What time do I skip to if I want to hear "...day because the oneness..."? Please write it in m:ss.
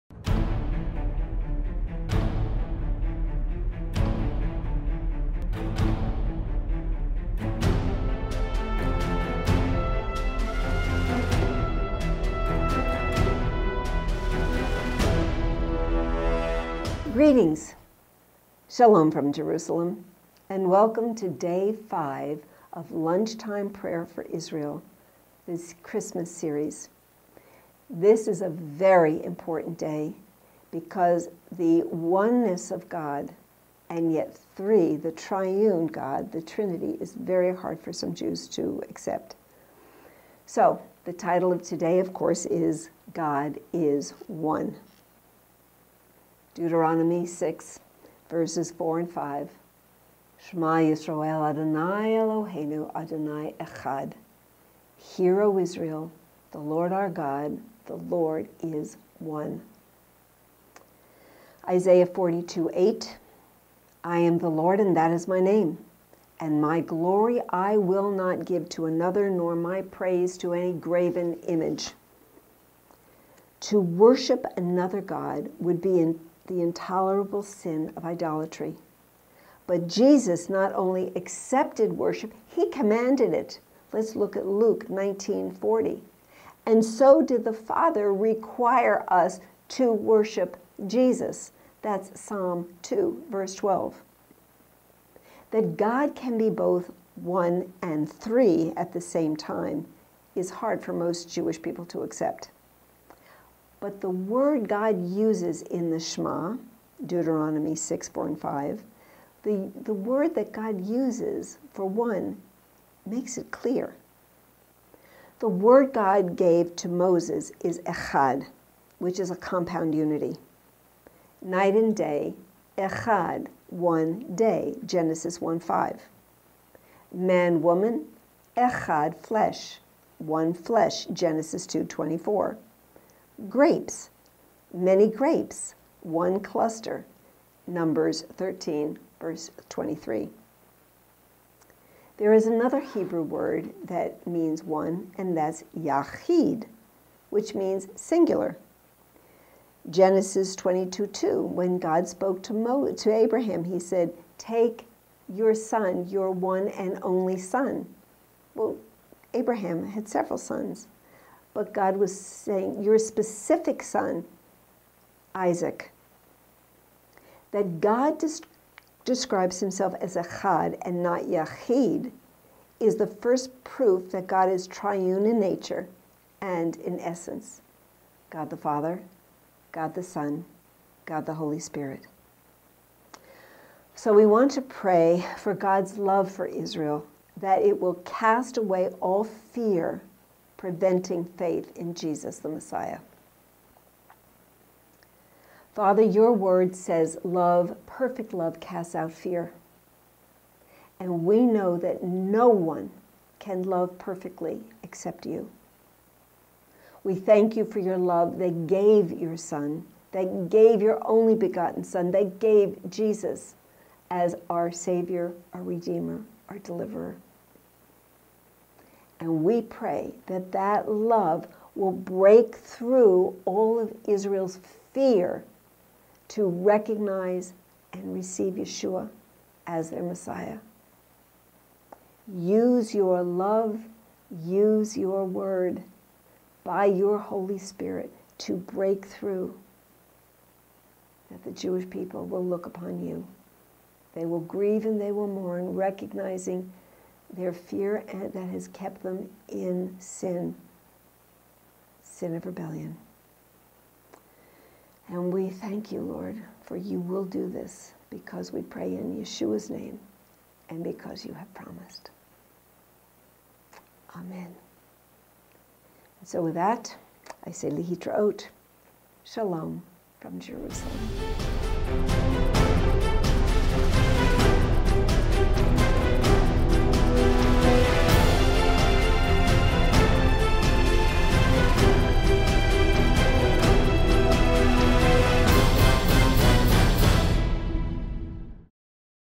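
0:29.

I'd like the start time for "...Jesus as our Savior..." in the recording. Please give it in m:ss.
3:32.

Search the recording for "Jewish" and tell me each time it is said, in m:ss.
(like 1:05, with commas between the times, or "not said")
1:41, 4:01.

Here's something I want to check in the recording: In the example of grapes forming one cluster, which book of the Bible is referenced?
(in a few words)
Numbers.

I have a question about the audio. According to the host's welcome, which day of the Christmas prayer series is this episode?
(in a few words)
Day 5.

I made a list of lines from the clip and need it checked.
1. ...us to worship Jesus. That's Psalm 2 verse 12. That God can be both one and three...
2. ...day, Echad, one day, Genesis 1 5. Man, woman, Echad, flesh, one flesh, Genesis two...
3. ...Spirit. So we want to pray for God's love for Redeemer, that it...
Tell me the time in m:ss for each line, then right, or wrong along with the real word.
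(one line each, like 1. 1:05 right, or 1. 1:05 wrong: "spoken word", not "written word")
1. 1:29 right
2. 2:01 right
3. 3:01 wrong: "Israel", not "Redeemer".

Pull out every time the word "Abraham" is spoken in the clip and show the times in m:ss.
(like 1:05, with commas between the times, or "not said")
2:33, 2:39.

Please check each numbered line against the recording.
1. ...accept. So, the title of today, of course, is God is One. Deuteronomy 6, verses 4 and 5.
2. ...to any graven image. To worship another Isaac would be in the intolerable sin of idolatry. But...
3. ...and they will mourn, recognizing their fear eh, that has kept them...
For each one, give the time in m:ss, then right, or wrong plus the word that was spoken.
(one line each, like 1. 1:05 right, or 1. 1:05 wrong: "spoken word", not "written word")
1. 0:38 right
2. 1:10 wrong: "God", not "Isaac"
3. 4:04 right.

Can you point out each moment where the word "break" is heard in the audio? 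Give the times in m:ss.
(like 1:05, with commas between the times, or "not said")
3:41, 3:58.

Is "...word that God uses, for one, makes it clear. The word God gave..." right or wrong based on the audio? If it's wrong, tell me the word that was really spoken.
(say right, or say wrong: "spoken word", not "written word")
right.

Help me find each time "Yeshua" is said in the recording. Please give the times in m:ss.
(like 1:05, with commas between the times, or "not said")
3:48, 4:19.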